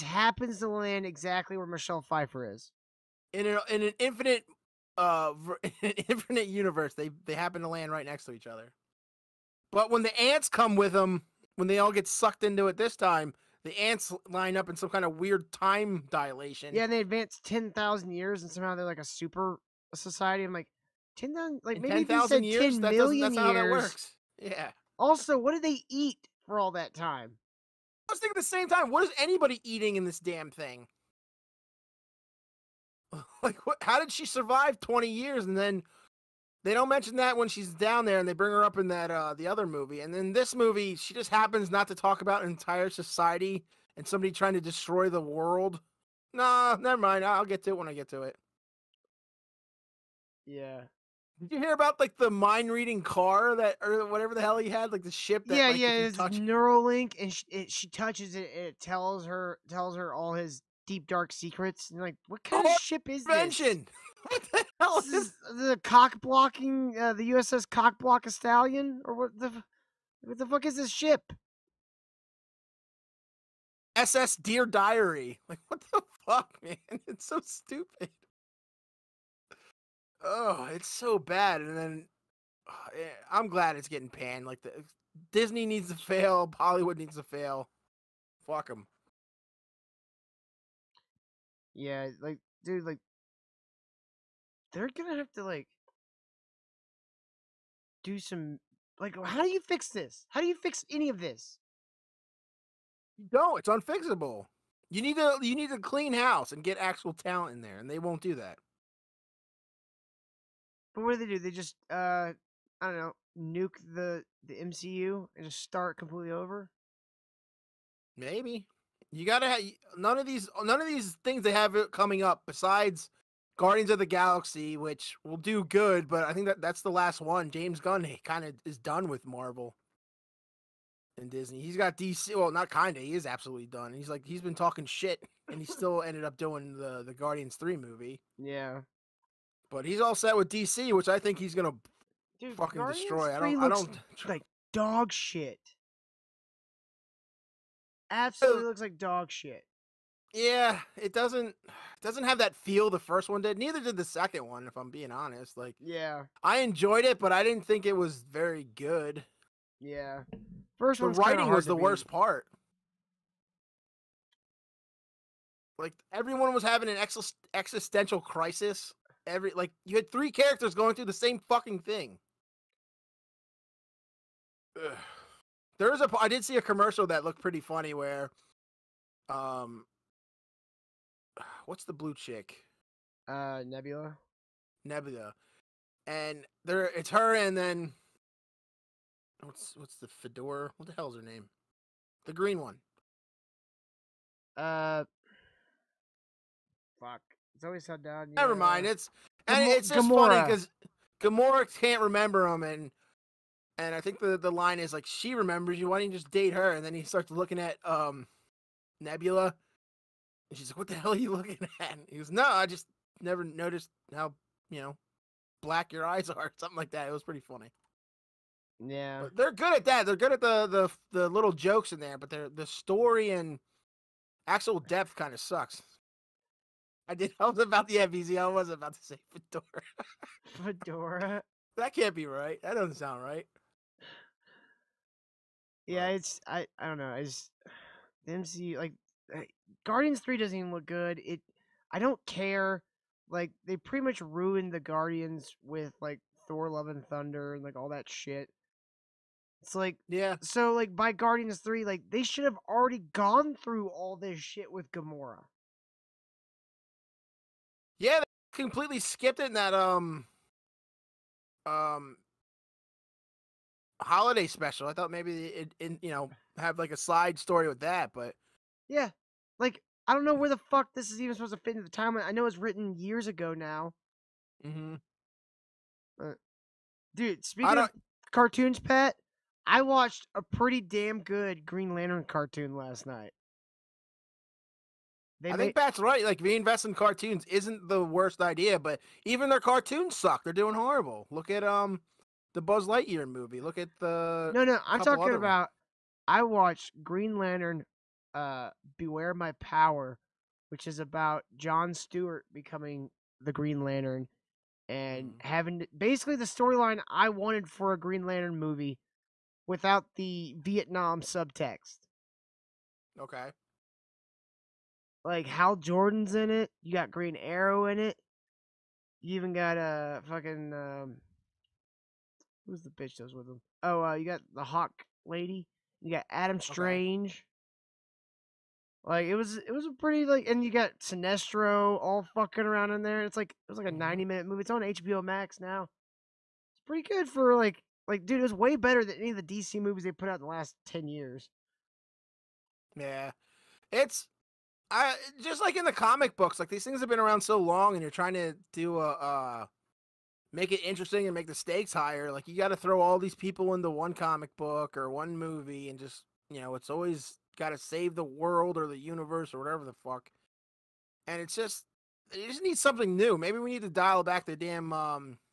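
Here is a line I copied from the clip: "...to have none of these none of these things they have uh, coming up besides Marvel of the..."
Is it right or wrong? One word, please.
wrong.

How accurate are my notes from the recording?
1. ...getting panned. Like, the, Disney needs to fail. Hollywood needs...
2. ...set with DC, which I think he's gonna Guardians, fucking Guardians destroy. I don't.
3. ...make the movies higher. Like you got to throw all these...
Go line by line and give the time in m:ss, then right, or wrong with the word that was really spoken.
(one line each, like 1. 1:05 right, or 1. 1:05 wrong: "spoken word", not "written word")
1. 1:23 right
2. 2:20 wrong: "Dude", not "Guardians"
3. 5:51 wrong: "stakes", not "movies".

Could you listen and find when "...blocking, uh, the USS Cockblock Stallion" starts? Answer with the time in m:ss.
1:06.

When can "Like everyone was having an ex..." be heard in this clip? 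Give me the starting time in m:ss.
2:45.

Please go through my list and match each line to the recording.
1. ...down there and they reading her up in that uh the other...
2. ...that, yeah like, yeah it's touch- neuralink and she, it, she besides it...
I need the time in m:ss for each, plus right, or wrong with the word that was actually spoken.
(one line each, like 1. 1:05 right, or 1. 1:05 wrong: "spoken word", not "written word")
1. 0:37 wrong: "bring", not "reading"
2. 0:55 wrong: "touches", not "besides".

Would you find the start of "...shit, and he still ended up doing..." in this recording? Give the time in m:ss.
2:14.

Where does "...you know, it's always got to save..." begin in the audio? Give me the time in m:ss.
5:56.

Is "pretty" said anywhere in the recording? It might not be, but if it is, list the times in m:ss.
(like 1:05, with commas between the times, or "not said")
2:57, 3:37, 4:03, 4:40, 5:29, 5:36.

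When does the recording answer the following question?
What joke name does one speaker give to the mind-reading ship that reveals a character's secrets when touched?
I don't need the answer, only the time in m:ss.
1:13.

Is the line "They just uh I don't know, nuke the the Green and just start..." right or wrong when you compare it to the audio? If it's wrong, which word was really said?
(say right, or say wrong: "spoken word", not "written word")
wrong: "MCU", not "Green".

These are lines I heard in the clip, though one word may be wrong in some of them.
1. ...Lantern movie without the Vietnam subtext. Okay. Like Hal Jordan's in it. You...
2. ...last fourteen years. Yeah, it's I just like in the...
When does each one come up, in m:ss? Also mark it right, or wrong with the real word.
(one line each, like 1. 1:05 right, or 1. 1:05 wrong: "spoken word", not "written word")
1. 5:08 right
2. 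5:40 wrong: "ten", not "fourteen".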